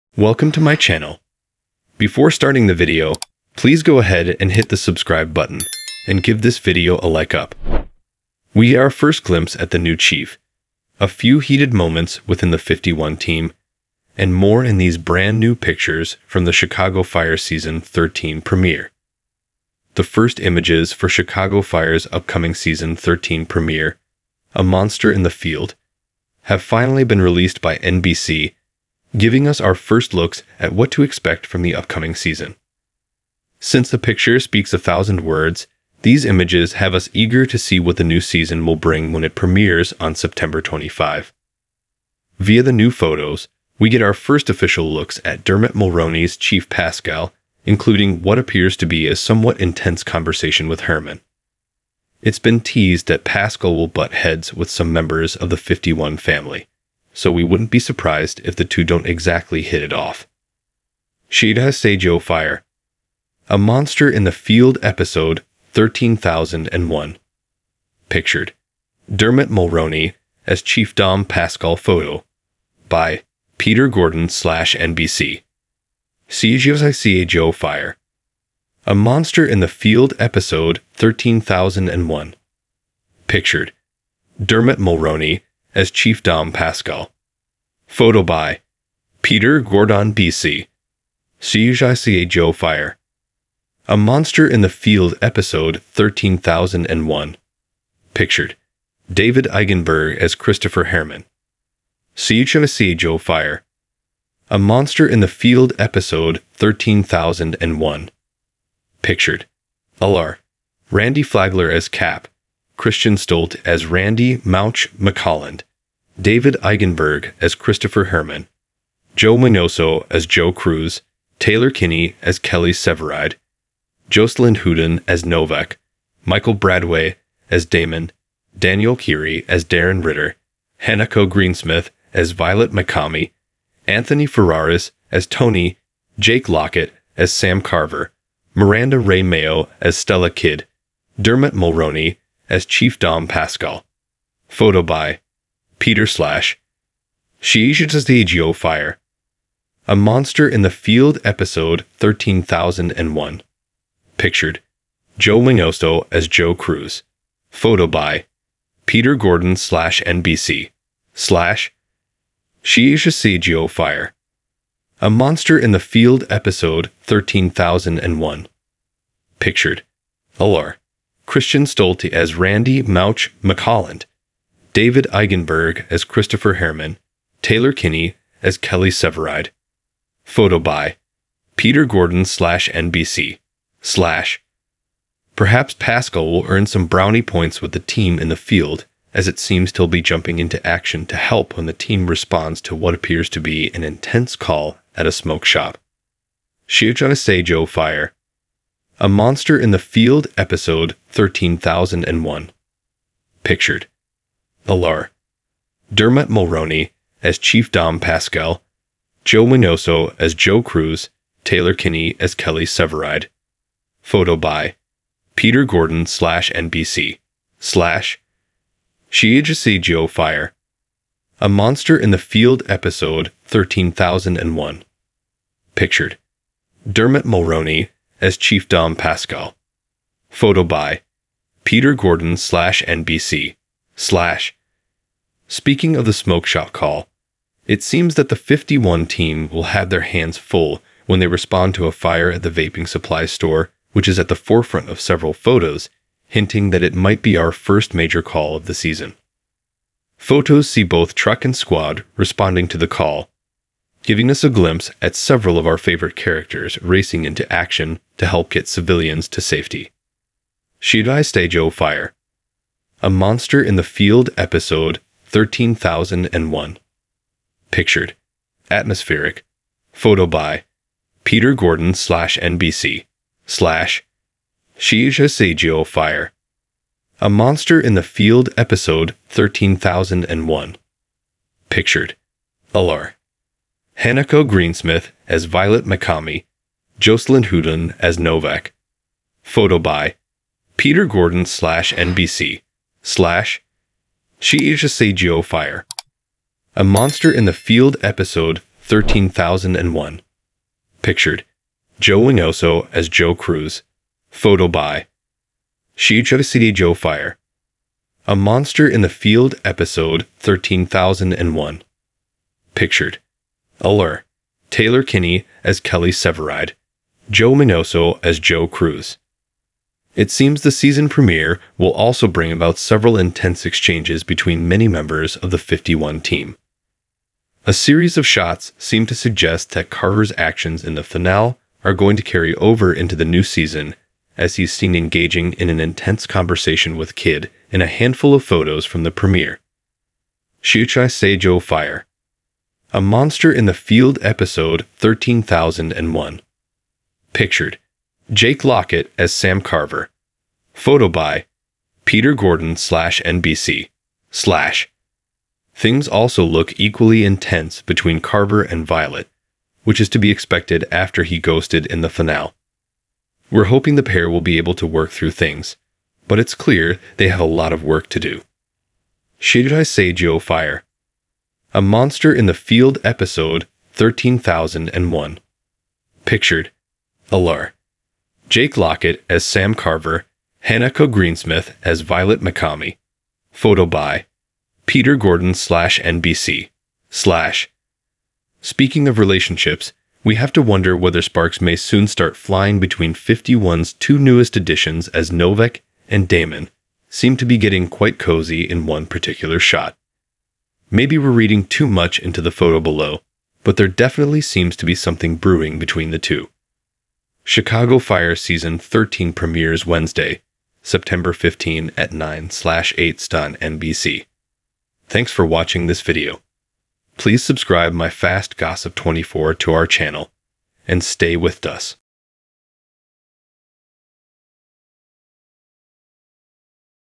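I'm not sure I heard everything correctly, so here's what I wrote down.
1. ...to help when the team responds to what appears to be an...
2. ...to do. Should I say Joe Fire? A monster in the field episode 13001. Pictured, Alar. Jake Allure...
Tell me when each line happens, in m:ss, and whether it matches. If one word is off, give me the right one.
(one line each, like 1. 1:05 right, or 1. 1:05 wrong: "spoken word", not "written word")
1. 3:11 right
2. 6:08 wrong: "Lockett", not "Allure".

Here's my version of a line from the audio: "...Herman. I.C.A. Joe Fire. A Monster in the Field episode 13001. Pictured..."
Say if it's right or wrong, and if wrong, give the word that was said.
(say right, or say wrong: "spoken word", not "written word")
right.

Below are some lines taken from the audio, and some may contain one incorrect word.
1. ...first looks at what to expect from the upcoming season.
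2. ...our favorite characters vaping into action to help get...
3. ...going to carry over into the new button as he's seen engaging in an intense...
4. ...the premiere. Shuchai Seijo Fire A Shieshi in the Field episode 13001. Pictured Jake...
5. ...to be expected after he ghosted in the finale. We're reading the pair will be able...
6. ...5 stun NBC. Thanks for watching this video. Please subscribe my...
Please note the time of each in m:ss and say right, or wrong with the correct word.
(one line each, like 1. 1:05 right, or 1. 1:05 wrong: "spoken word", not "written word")
1. 0:29 right
2. 4:15 wrong: "racing", not "vaping"
3. 5:31 wrong: "season", not "button"
4. 5:39 wrong: "Monster", not "Shieshi"
5. 6:00 wrong: "hoping", not "reading"
6. 6:52 wrong: "8", not "5".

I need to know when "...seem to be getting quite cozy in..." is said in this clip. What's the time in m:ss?
6:37.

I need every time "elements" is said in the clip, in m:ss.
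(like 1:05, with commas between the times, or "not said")
not said.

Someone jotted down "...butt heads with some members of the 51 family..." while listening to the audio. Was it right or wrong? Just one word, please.
right.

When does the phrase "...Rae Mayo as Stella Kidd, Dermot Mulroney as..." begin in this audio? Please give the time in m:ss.
2:18.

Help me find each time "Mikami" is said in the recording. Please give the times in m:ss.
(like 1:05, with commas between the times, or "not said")
2:12, 4:45, 6:22.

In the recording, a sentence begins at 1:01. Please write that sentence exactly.
Shida Seijo Fire A Monster in the Field episode 13001.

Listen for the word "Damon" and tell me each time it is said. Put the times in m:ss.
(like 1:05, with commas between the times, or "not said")
2:07, 6:36.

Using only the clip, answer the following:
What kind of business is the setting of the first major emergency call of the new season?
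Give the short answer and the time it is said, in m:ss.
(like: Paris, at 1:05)
vaping supply store, at 4:02.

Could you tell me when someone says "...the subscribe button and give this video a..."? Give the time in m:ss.
0:04.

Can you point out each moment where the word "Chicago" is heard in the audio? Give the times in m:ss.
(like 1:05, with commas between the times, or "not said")
0:16, 0:21, 6:47.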